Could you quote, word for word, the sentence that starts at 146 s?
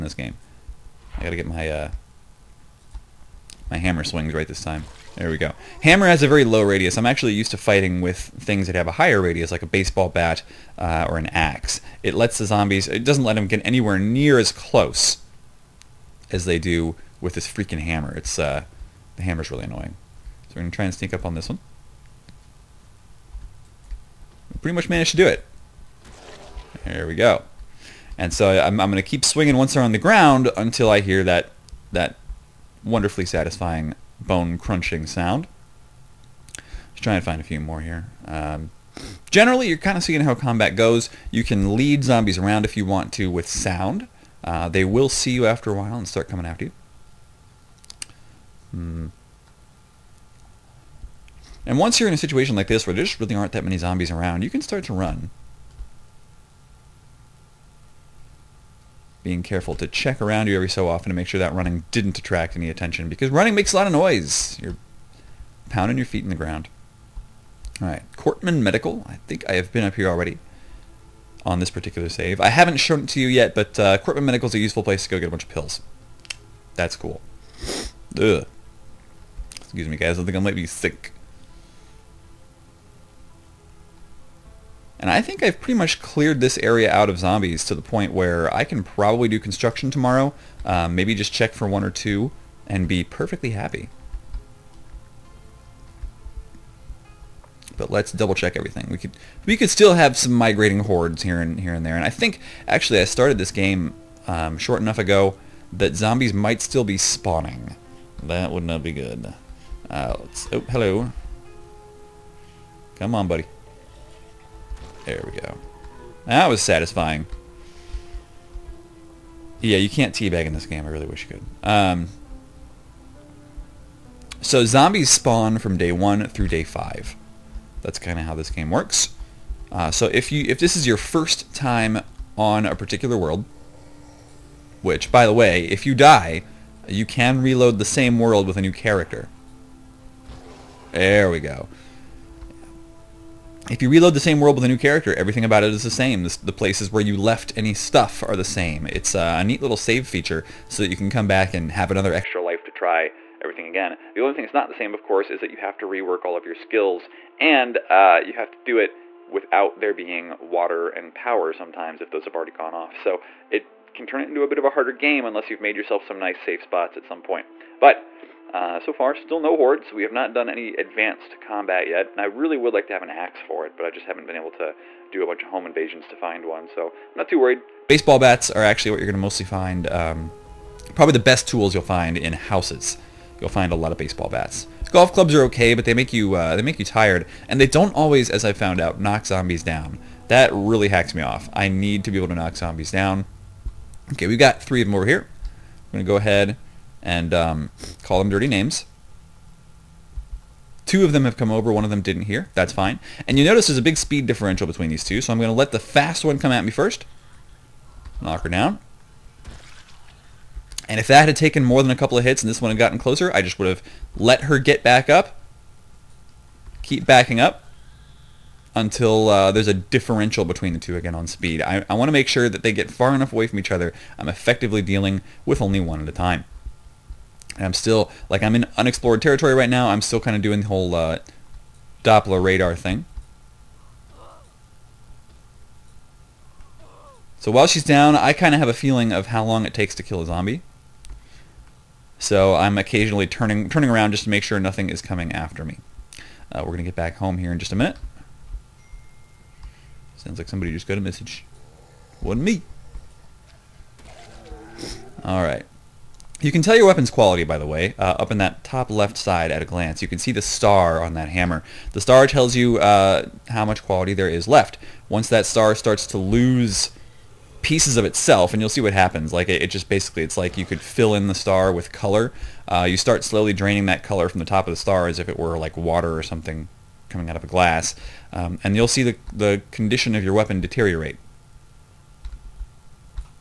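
the places where you left any stuff are the same.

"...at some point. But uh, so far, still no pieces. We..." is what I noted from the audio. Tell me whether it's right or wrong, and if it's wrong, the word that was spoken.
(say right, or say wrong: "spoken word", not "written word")
wrong: "hordes", not "pieces".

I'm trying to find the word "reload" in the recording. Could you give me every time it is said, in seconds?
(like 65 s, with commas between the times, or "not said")
137 s, 143 s.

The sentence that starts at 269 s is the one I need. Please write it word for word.
Like it, it just basically, it's like you could fill in the star with color.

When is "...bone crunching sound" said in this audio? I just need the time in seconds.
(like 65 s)
34 s.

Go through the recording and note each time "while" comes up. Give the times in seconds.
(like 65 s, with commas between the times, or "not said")
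45 s, 237 s.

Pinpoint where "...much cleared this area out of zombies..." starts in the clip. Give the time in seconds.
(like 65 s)
85 s.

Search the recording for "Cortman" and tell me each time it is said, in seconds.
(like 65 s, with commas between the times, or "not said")
68 s, 73 s.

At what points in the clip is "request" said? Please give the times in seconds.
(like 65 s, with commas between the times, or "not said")
not said.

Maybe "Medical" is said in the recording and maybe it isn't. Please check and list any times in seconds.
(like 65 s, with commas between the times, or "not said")
68 s, 74 s.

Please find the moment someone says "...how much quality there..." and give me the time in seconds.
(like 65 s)
263 s.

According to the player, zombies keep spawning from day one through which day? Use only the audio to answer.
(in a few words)
day 5.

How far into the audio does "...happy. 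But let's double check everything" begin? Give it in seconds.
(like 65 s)
93 s.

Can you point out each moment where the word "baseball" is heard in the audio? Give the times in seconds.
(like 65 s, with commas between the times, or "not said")
9 s, 177 s, 183 s.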